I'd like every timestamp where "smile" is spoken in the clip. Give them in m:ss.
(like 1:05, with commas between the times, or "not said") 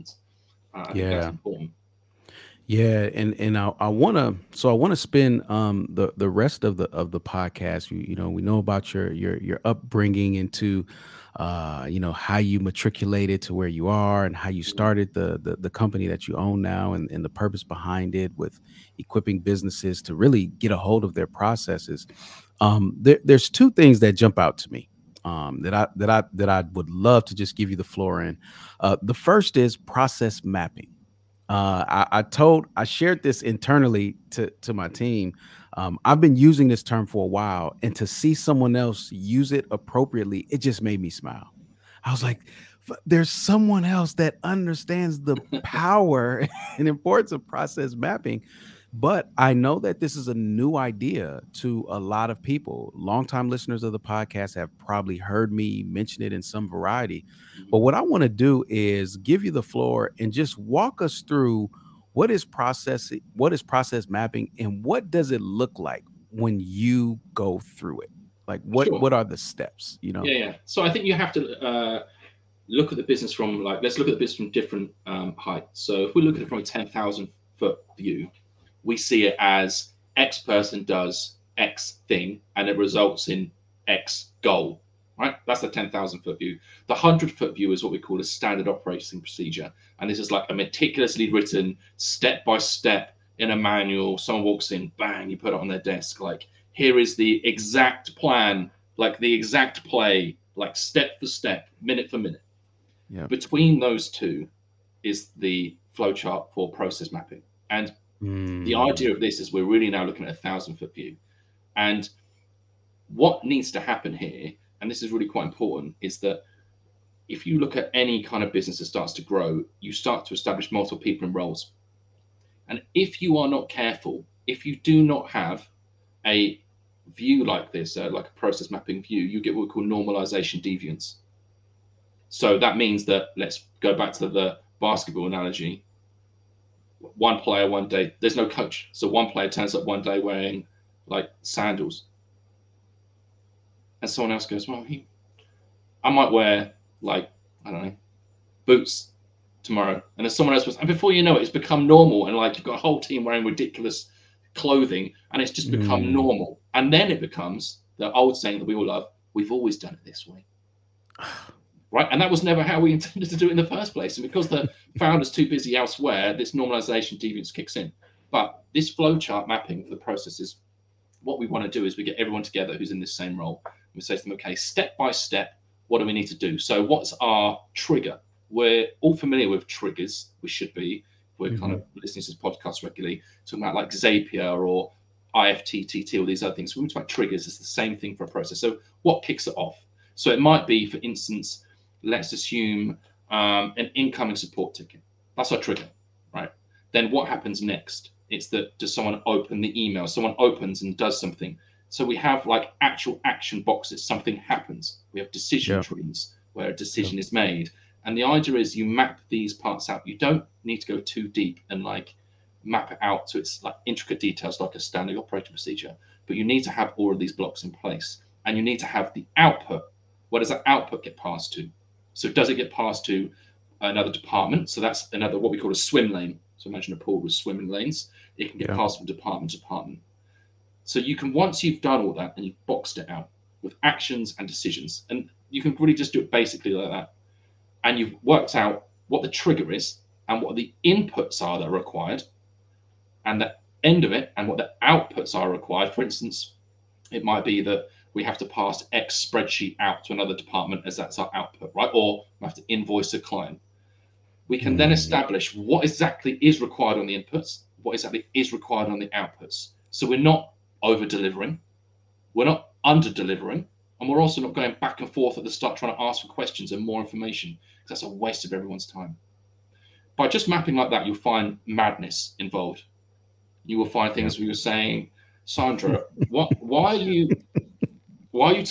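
0:41.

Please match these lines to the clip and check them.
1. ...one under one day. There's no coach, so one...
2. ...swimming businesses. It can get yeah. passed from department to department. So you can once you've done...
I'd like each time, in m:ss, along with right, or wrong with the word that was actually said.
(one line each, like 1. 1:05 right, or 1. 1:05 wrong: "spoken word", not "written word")
1. 2:17 wrong: "player", not "under"
2. 3:47 wrong: "lanes", not "businesses".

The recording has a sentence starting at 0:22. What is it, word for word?
Um there, there's two things that jump out to me.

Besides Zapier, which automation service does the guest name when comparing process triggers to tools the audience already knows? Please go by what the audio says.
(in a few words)
IFTTT.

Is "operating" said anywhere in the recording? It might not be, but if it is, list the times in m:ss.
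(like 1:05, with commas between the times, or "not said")
1:28, 3:35.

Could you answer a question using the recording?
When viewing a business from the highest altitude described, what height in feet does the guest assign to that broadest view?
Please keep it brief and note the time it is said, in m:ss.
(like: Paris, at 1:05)
10,000, at 1:16.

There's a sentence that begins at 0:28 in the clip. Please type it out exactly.
Uh, the first is process mapping.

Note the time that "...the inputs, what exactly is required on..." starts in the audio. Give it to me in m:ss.
4:17.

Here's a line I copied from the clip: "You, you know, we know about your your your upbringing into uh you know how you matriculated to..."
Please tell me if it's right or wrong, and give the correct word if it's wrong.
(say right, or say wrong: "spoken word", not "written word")
right.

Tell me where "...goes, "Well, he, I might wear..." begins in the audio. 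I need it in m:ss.
2:24.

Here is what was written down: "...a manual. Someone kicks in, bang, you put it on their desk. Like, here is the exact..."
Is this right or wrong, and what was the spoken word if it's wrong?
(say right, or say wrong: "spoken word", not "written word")
wrong: "walks", not "kicks".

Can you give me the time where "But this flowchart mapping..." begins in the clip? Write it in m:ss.
2:48.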